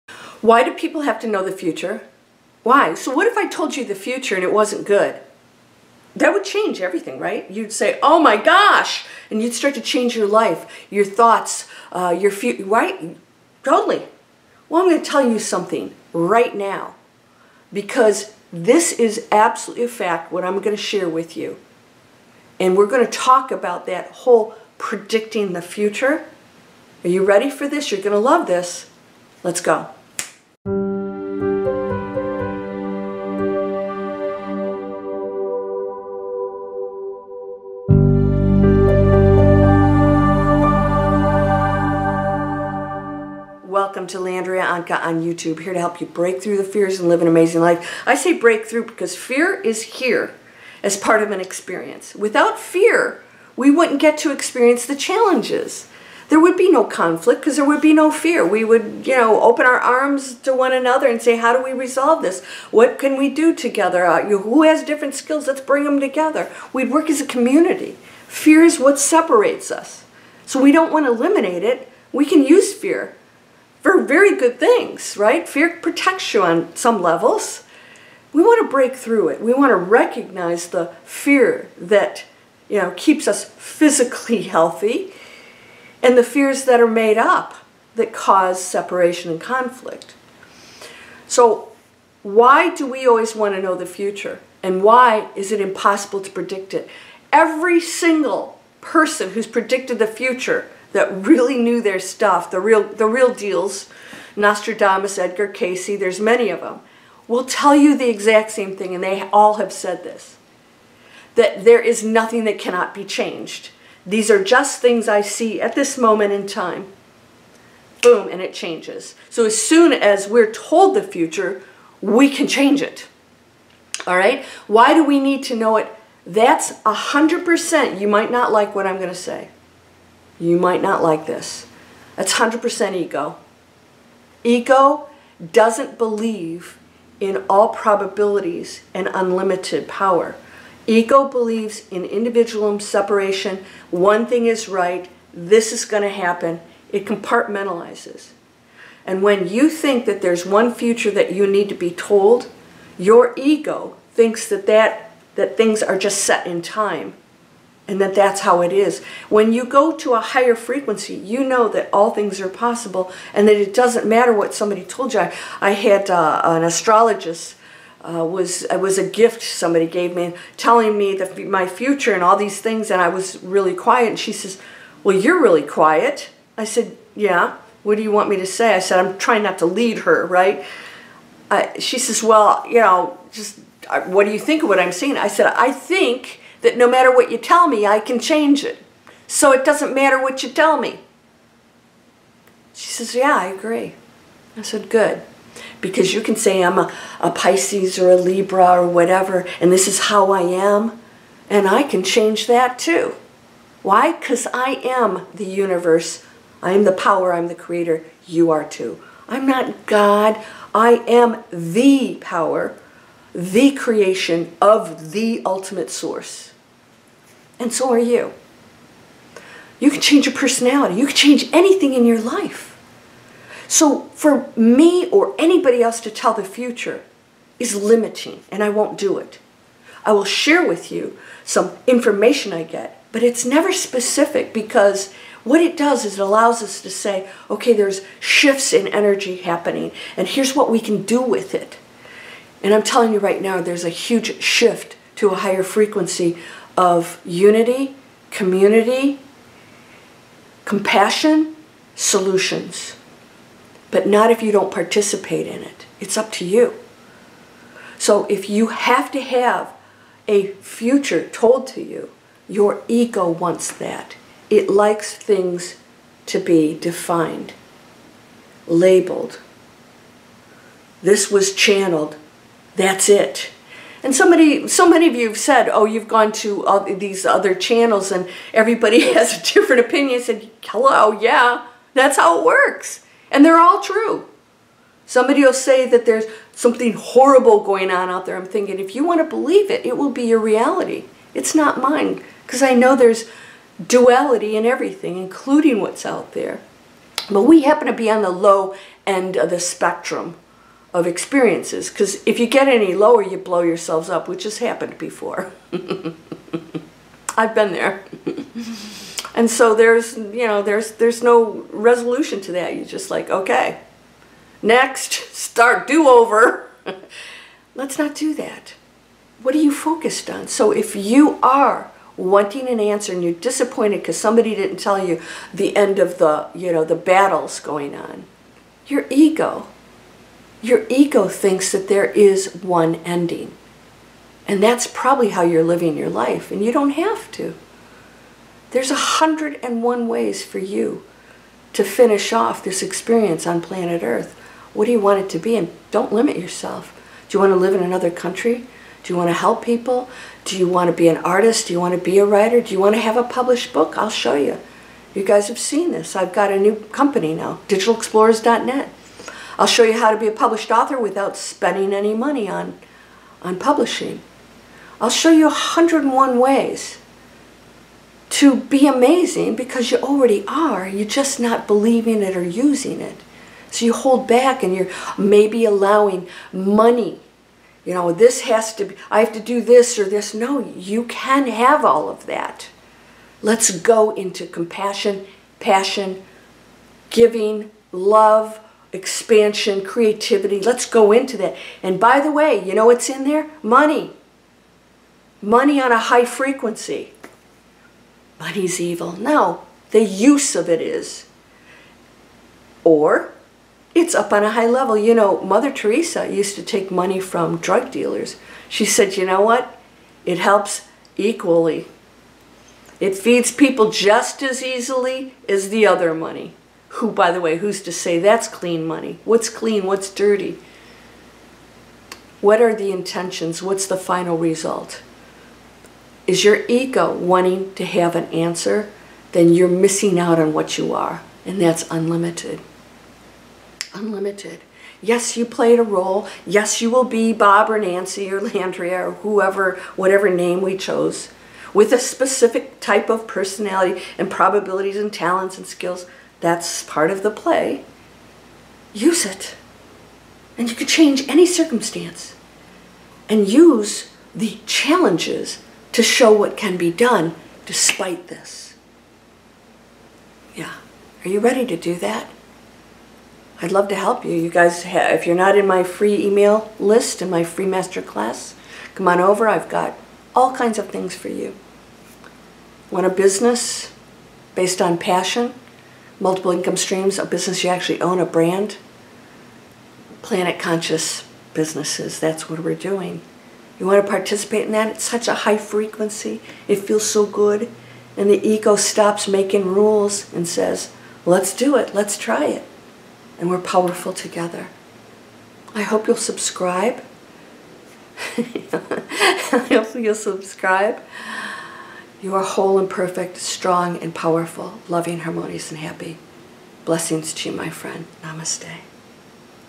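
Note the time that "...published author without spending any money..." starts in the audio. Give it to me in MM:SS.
06:00.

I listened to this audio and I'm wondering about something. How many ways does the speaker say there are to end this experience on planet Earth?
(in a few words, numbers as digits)
101.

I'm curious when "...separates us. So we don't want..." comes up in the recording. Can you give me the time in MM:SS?
01:08.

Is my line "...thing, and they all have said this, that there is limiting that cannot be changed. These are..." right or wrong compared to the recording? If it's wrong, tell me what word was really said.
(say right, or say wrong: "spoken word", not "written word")
wrong: "nothing", not "limiting".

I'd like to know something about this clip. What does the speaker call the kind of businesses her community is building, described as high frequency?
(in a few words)
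Planet conscious businesses.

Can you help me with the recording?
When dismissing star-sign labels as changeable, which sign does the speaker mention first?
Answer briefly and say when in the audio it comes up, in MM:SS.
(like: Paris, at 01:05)
Pisces, at 03:17.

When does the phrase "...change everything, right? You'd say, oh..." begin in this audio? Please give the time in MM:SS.
00:06.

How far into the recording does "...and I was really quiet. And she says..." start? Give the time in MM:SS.
02:52.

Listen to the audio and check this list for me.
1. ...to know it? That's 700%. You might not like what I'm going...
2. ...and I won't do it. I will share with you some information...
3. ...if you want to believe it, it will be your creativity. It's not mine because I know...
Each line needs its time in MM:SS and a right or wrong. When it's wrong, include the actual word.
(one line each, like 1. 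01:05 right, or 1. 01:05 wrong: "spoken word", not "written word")
1. 02:05 wrong: "100", not "700"
2. 03:48 right
3. 04:48 wrong: "reality", not "creativity".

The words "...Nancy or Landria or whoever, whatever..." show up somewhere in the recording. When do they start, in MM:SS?
07:17.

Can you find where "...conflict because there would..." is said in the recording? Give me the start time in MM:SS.
00:56.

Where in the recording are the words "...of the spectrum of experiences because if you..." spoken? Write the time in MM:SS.
04:59.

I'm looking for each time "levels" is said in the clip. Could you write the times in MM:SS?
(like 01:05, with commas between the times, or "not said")
01:17, 06:44.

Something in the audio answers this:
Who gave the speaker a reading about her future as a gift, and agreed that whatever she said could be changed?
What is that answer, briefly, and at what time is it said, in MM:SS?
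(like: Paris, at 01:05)
An astrologist, at 02:46.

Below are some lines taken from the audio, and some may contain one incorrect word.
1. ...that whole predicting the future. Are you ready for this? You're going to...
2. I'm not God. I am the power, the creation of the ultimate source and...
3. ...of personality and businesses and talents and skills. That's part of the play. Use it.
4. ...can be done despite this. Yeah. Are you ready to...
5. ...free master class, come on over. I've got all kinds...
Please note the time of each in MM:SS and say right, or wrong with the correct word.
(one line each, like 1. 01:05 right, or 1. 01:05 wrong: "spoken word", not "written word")
1. 00:23 right
2. 03:29 right
3. 07:23 wrong: "probabilities", not "businesses"
4. 07:36 right
5. 07:47 right.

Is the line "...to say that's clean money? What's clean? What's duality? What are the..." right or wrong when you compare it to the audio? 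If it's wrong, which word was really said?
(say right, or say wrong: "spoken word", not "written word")
wrong: "dirty", not "duality".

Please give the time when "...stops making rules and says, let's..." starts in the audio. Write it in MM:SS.
08:08.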